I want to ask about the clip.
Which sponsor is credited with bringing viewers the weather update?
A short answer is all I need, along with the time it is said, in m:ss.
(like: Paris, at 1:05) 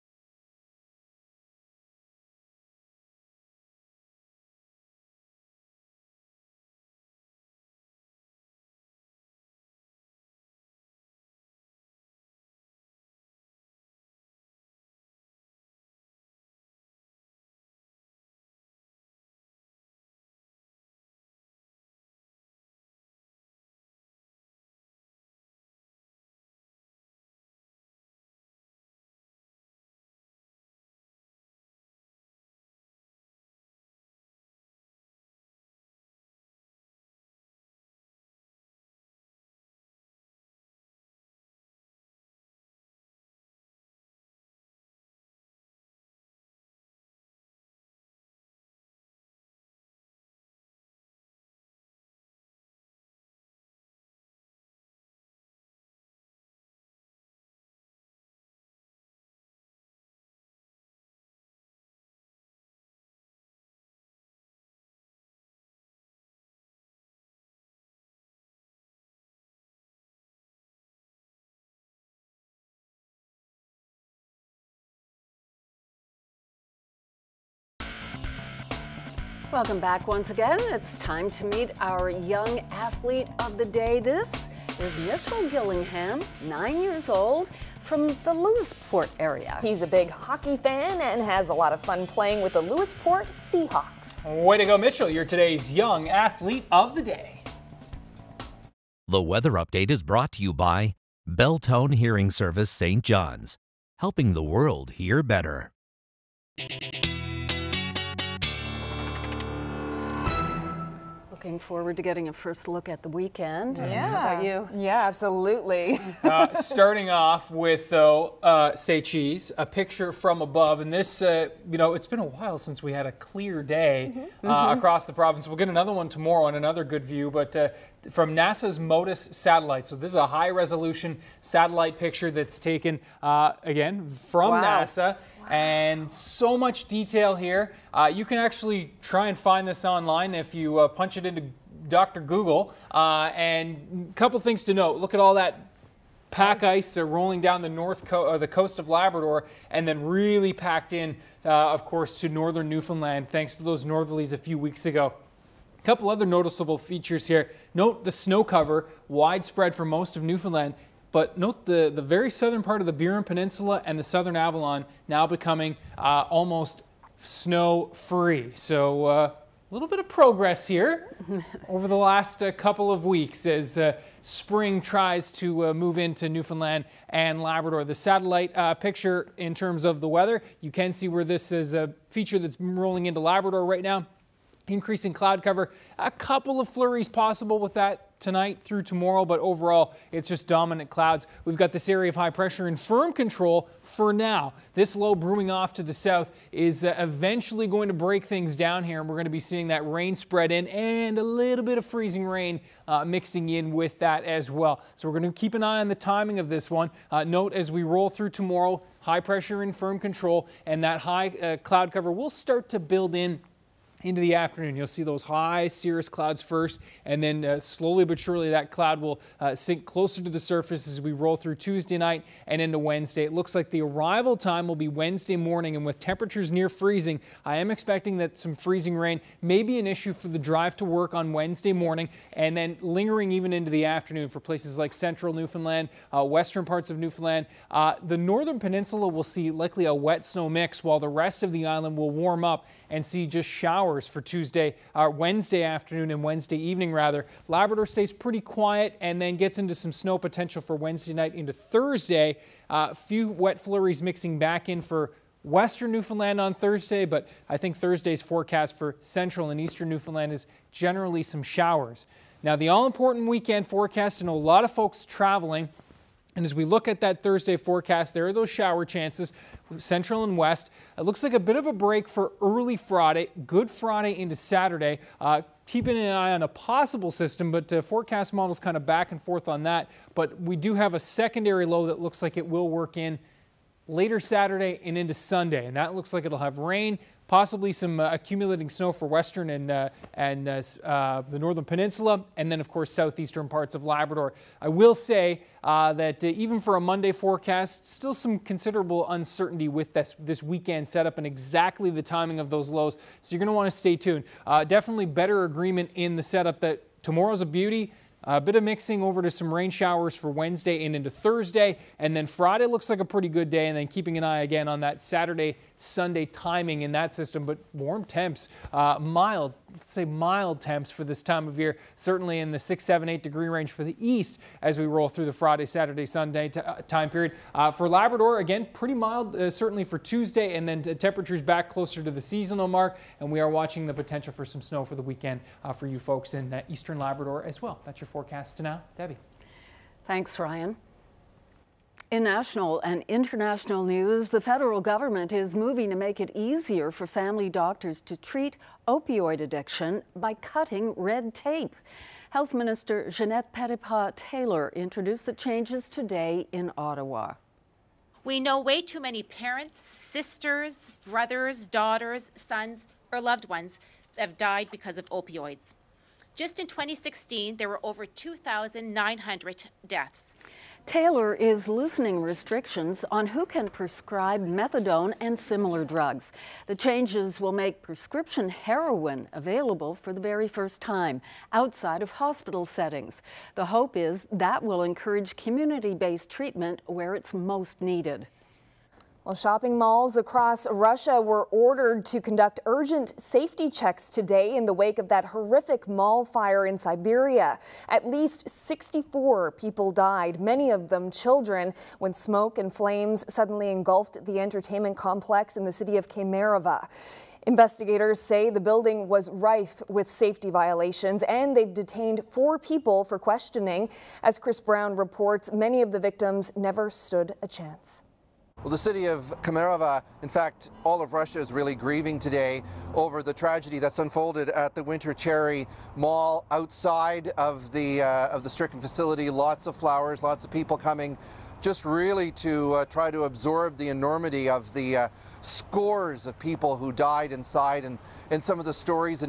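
Beltone Hearing Service, at 1:41.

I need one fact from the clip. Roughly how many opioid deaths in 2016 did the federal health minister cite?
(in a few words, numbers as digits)
2,900.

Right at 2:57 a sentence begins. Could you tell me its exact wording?
The satellite picture in terms of the weather, you can see where this is a feature that's rolling into Labrador right now.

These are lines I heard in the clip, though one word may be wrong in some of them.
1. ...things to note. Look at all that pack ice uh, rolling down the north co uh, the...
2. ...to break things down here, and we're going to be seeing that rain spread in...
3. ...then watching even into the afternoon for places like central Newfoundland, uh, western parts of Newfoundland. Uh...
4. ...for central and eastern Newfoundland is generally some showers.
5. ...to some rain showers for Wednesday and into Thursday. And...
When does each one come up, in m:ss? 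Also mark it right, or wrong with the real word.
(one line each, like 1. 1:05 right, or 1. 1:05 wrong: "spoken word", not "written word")
1. 2:24 right
2. 3:17 right
3. 3:52 wrong: "lingering", not "watching"
4. 4:18 right
5. 5:09 right.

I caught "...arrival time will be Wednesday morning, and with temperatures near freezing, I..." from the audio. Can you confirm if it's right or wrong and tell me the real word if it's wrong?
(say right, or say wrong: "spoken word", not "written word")
right.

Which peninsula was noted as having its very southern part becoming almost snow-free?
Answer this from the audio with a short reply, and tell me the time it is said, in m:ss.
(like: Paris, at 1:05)
Burin Peninsula, at 2:42.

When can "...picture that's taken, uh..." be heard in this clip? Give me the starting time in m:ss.
2:11.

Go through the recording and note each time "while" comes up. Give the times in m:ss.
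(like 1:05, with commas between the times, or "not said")
2:02, 4:00.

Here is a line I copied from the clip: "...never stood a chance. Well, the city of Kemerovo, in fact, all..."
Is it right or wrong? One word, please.
right.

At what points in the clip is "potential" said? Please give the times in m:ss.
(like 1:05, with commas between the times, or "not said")
4:10, 5:33.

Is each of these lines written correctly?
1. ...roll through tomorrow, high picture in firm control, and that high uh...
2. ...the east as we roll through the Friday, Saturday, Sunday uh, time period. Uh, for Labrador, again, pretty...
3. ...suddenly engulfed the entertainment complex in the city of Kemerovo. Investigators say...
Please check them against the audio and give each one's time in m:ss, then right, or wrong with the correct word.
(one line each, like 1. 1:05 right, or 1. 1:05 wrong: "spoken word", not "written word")
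1. 3:27 wrong: "pressure", not "picture"
2. 5:23 right
3. 6:43 right.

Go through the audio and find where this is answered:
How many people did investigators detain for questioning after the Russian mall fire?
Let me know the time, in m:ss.
6:52.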